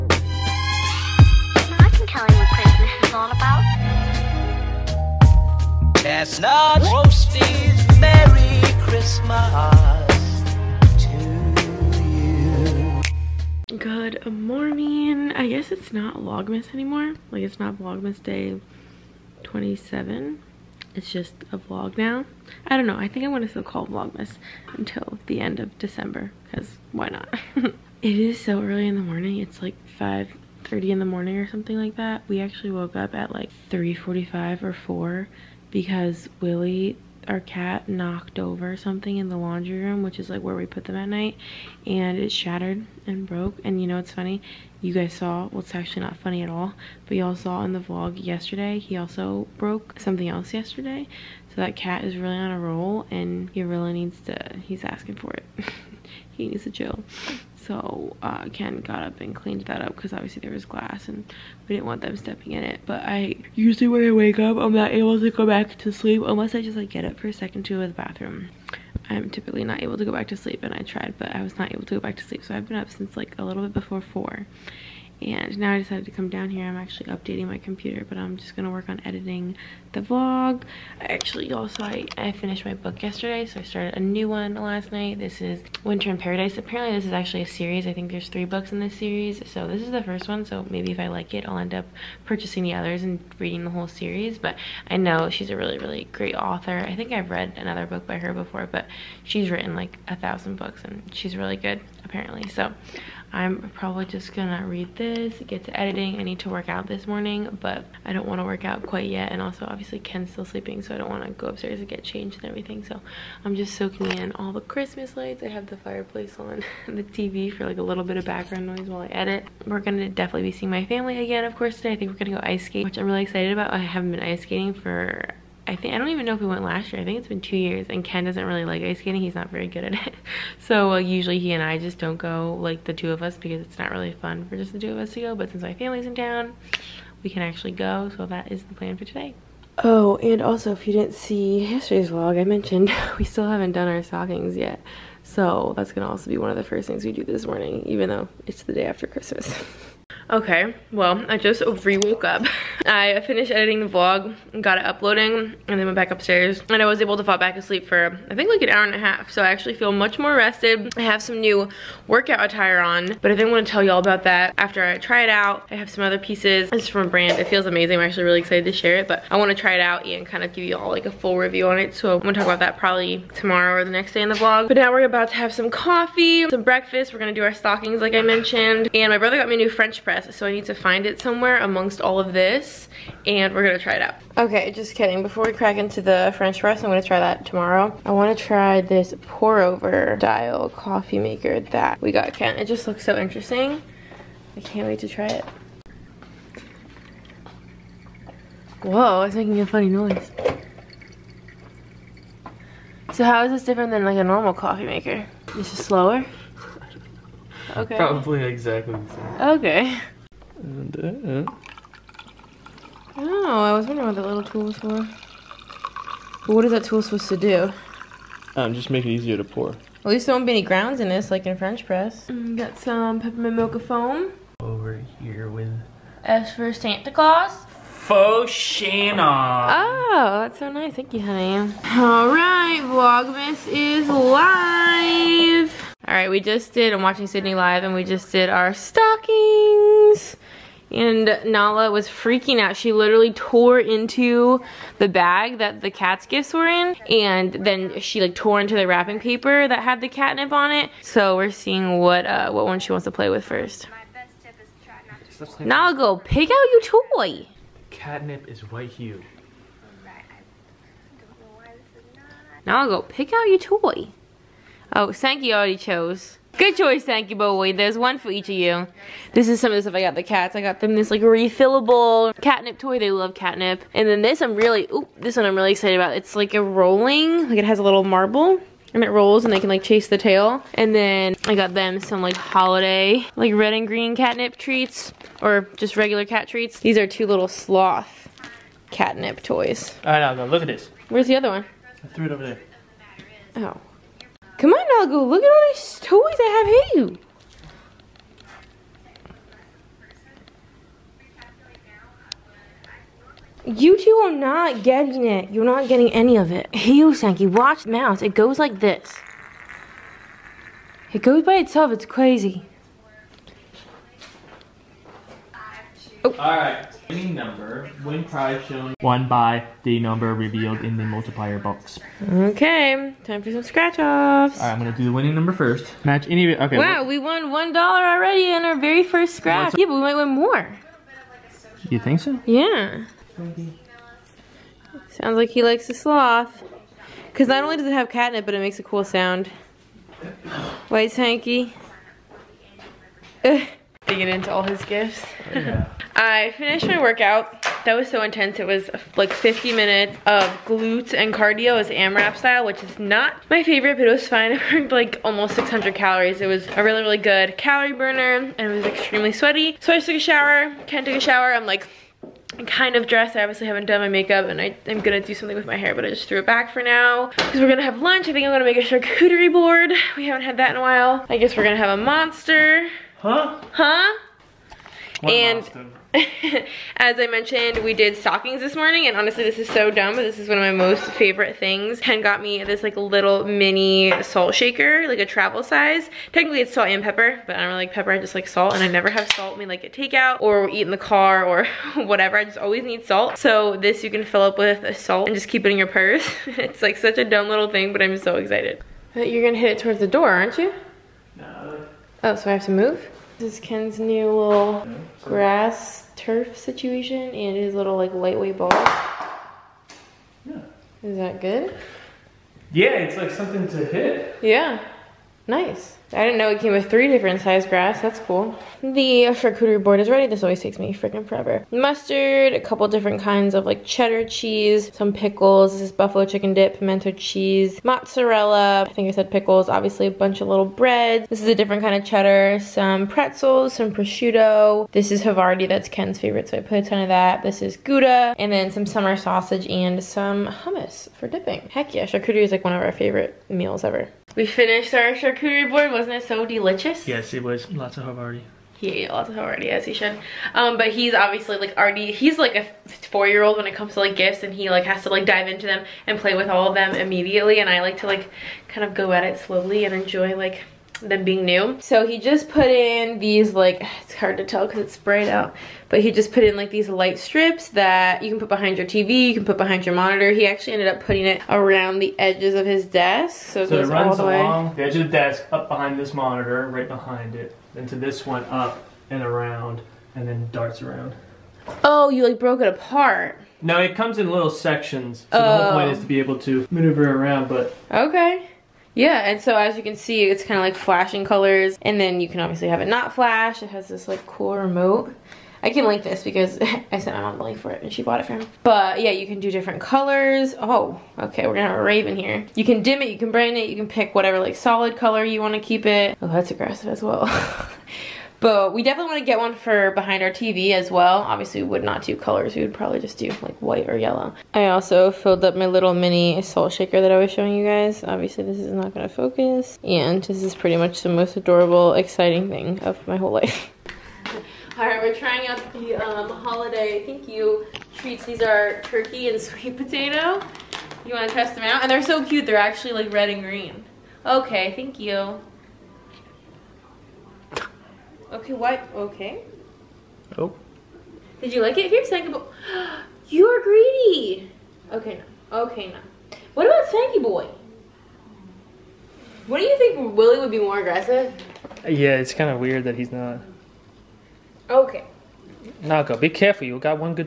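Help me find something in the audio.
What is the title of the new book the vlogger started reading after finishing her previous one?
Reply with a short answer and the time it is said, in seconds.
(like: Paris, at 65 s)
Winter in Paradise, at 85 s.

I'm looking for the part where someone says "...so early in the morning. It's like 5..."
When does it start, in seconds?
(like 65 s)
28 s.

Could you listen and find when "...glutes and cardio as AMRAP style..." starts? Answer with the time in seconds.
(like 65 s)
350 s.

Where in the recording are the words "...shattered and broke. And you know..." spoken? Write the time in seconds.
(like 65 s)
42 s.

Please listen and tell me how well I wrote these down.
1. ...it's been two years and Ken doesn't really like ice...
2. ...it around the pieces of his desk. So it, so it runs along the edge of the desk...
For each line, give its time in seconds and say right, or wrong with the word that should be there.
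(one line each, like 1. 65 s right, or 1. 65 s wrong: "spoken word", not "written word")
1. 127 s right
2. 471 s wrong: "edges", not "pieces".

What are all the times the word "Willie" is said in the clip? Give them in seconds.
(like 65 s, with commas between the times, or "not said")
36 s, 550 s.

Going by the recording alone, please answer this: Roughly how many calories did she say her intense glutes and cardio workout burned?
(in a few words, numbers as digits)
600.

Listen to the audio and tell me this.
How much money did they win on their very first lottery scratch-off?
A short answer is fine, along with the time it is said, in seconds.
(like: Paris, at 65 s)
1 dollar, at 327 s.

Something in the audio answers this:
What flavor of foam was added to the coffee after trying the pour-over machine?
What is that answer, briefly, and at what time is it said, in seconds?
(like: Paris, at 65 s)
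Peppermint mocha, at 223 s.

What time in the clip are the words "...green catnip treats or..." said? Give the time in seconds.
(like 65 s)
283 s.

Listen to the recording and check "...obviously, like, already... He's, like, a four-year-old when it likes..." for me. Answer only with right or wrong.
wrong.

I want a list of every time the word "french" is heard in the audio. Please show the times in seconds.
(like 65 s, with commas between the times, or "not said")
179 s, 186 s, 221 s.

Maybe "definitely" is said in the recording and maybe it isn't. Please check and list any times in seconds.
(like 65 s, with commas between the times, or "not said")
120 s, 508 s.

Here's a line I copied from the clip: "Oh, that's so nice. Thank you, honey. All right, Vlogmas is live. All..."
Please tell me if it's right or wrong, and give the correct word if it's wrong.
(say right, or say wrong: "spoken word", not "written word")
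right.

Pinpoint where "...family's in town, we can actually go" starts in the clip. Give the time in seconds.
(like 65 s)
135 s.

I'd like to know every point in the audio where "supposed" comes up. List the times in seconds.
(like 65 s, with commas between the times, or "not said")
217 s.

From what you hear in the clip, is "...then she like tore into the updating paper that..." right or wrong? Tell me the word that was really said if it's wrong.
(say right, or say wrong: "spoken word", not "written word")
wrong: "wrapping", not "updating".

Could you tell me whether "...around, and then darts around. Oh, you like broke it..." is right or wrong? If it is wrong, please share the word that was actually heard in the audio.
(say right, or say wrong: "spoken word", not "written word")
right.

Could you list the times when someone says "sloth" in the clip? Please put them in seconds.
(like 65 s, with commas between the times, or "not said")
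287 s, 335 s.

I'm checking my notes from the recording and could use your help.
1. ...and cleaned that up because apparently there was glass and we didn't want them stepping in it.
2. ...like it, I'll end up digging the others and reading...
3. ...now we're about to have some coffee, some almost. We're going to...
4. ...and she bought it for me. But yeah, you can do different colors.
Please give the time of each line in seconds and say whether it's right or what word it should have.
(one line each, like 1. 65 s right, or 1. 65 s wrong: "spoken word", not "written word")
1. 59 s wrong: "obviously", not "apparently"
2. 91 s wrong: "purchasing", not "digging"
3. 174 s wrong: "breakfast", not "almost"
4. 497 s right.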